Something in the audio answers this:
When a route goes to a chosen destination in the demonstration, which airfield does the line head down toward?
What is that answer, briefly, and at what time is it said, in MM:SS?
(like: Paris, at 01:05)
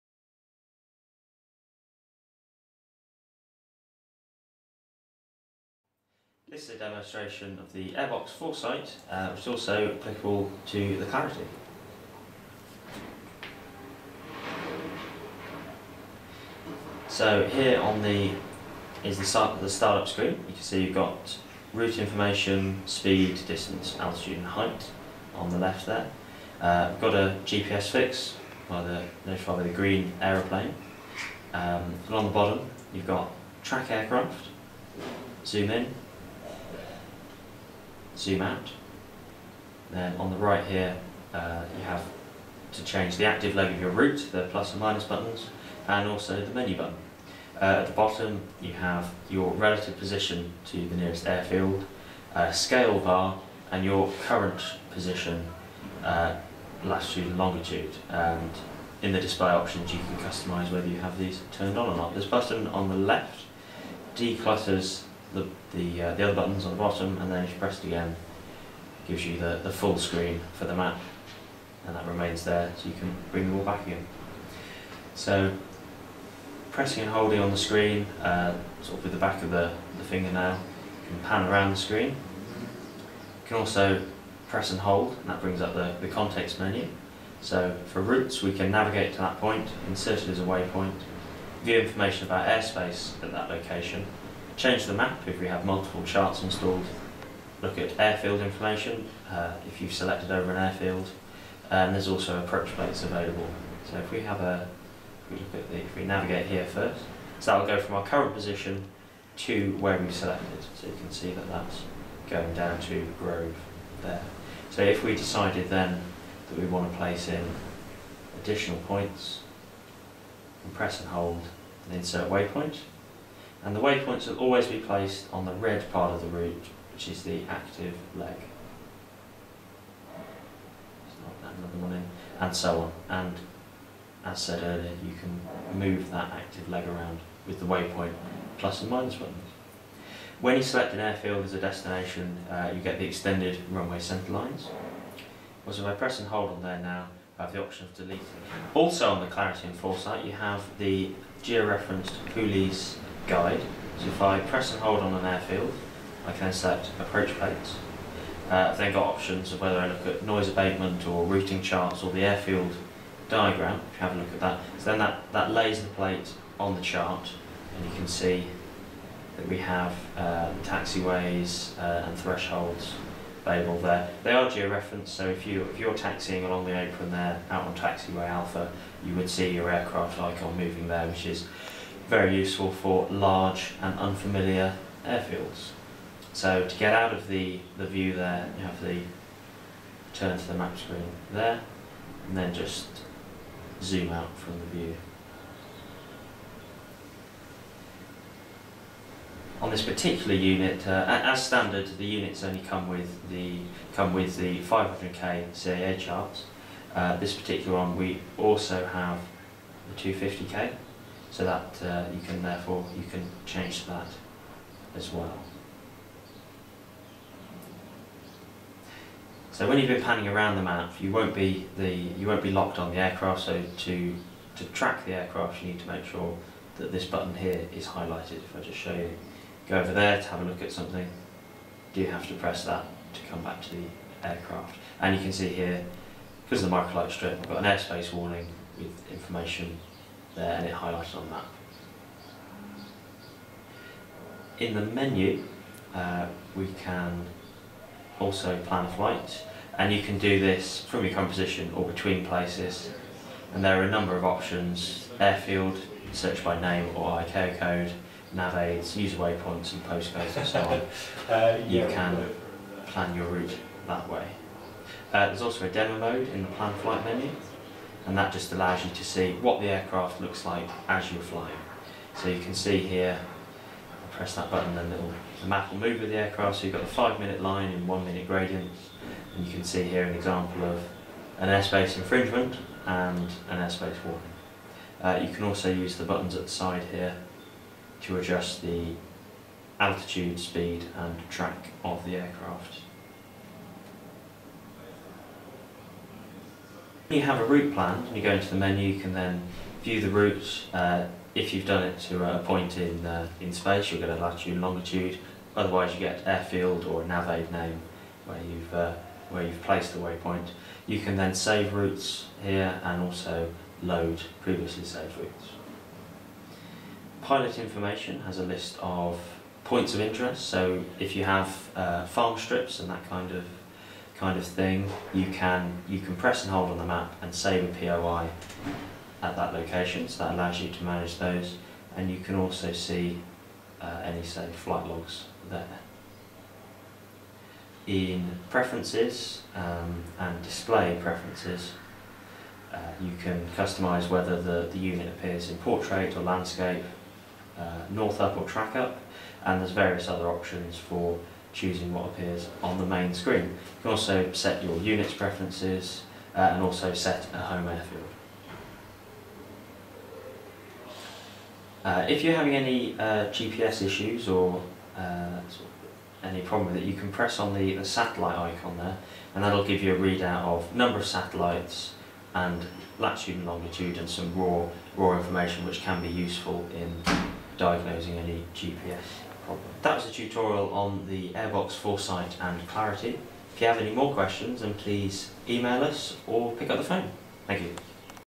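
Grove, at 01:53.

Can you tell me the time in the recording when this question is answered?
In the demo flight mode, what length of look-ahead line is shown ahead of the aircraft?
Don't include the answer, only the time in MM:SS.
04:36.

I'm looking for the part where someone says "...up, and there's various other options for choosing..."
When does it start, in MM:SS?
05:48.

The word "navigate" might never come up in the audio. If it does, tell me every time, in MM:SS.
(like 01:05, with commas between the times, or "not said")
01:28, 01:46.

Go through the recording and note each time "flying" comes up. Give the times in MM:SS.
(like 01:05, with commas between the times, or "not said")
04:31.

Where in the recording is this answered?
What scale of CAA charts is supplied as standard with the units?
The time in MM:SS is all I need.
03:24.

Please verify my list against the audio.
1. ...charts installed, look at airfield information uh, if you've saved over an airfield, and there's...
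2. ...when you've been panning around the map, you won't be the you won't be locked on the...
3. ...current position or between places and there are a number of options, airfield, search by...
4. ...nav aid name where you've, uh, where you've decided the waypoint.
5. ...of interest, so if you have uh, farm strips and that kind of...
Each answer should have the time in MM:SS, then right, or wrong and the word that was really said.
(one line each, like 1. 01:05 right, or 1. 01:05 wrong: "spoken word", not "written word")
1. 01:36 wrong: "selected", not "saved"
2. 03:39 right
3. 04:11 right
4. 05:07 wrong: "placed", not "decided"
5. 05:19 right.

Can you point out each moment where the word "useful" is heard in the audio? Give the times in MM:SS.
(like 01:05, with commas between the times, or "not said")
03:02, 06:16.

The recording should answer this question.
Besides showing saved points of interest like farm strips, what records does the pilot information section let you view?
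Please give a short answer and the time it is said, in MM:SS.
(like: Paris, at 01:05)
flight logs, at 05:34.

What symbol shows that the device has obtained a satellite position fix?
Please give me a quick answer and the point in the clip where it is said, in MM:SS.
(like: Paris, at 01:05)
green aeroplane, at 00:29.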